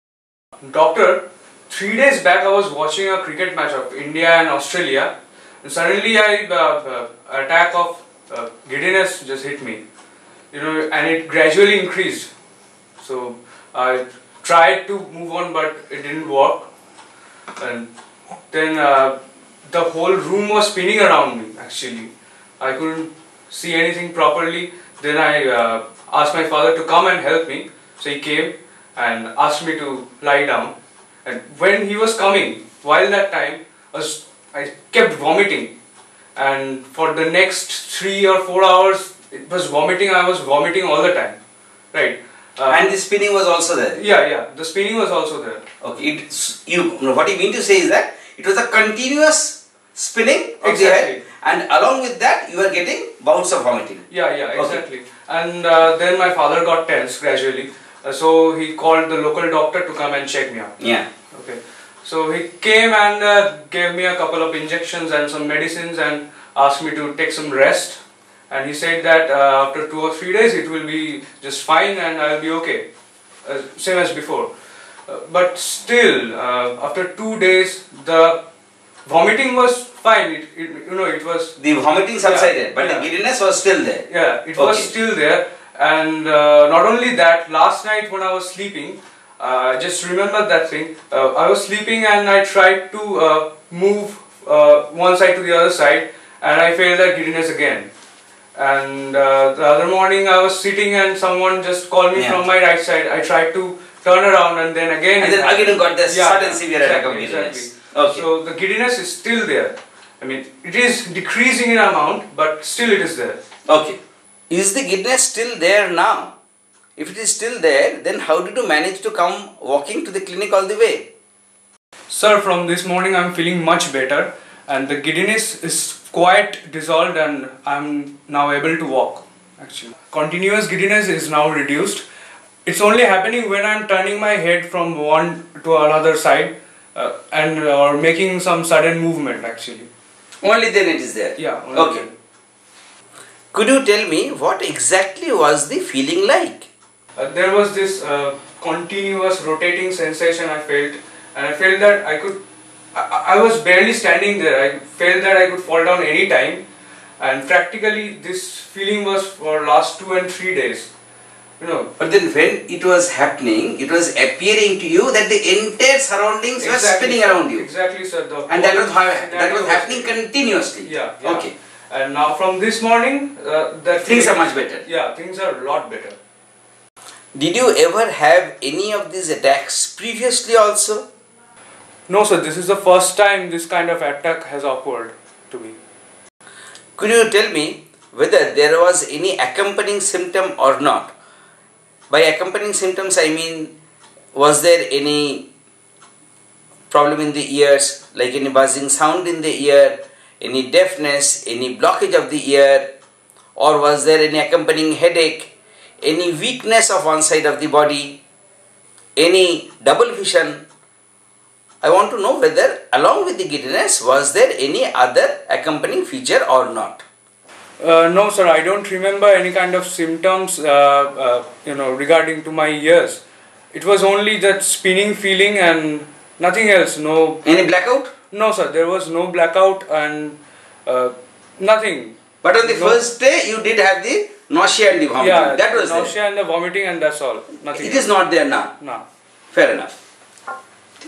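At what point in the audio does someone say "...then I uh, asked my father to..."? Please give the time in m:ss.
0:25.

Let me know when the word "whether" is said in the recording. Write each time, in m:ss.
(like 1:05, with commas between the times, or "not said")
3:08, 3:32.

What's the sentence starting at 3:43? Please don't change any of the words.
It was only that spinning feeling and nothing else.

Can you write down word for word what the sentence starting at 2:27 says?
Uh, there was this uh, continuous rotating sensation I felt and I felt that I could, I, I, was barely standing there.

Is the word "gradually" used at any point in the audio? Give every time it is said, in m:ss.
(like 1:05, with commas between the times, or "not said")
0:11, 0:57.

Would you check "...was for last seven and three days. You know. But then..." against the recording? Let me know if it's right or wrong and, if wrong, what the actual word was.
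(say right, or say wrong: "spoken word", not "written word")
wrong: "two", not "seven".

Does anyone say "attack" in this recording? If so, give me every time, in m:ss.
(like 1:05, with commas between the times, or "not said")
0:07, 1:46, 2:59, 3:04.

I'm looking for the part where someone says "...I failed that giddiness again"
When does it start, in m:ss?
1:36.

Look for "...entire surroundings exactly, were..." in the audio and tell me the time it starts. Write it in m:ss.
2:45.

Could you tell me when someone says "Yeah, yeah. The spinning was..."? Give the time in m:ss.
0:44.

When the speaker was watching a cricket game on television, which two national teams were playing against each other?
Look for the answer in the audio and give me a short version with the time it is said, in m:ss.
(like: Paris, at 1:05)
India and Australia, at 0:03.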